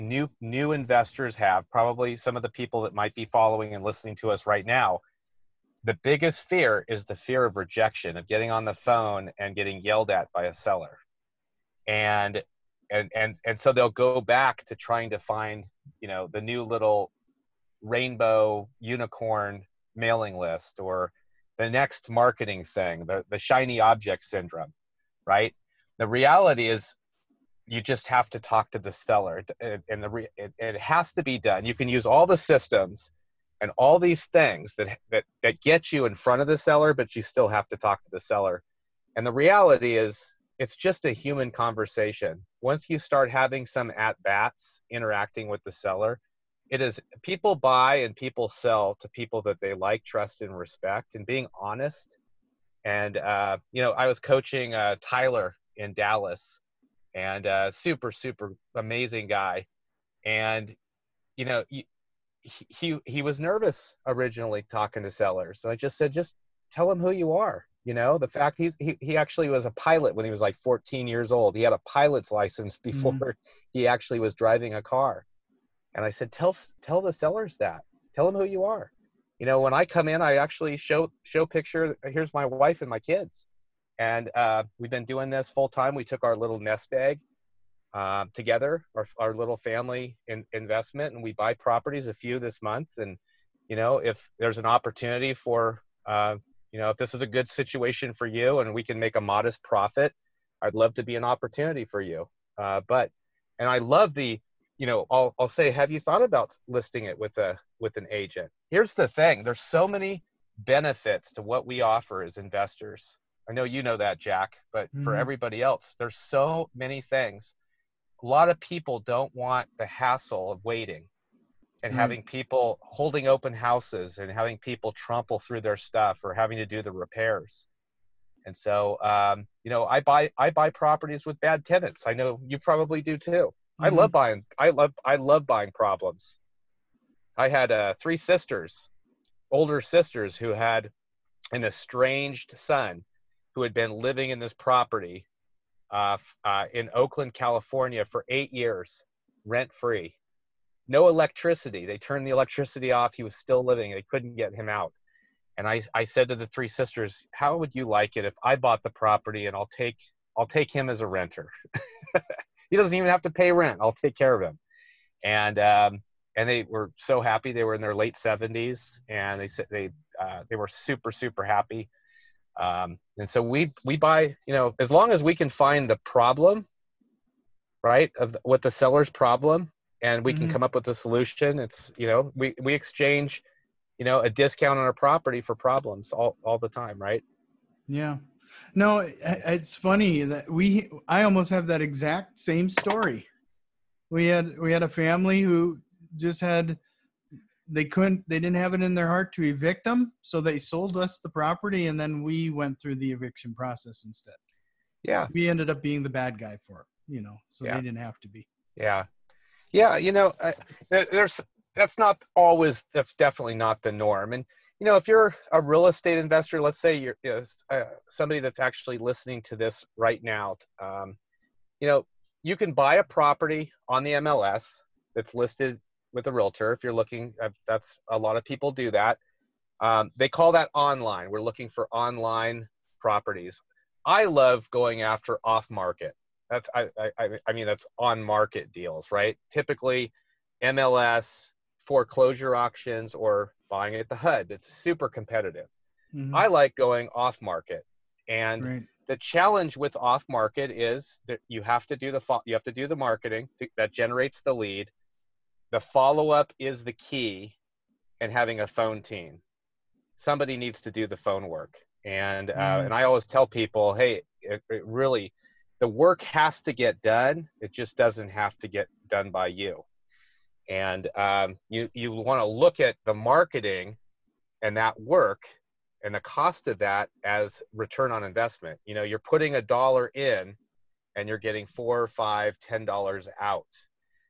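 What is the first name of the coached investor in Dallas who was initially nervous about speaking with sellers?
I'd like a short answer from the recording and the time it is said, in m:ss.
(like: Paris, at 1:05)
Tyler, at 0:54.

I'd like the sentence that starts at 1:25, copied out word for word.
We took our little nest egg uh, together, our, our little family in, investment, and we buy properties, a few this month.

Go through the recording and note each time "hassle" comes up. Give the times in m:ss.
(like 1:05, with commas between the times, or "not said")
1:59.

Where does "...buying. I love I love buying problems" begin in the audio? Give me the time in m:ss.
2:14.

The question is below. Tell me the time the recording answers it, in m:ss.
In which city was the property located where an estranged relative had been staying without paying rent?
2:26.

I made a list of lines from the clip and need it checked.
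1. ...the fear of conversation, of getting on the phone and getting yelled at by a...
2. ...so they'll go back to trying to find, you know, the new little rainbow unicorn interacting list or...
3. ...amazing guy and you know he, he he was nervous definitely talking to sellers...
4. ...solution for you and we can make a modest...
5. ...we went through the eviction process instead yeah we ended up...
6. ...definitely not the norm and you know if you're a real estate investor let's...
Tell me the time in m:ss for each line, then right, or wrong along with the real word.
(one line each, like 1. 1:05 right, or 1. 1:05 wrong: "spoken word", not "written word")
1. 0:07 wrong: "rejection", not "conversation"
2. 0:13 wrong: "mailing", not "interacting"
3. 0:58 wrong: "originally", not "definitely"
4. 1:37 wrong: "situation", not "solution"
5. 3:22 right
6. 3:33 right.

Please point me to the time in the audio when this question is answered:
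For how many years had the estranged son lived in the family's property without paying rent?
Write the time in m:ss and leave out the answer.
2:28.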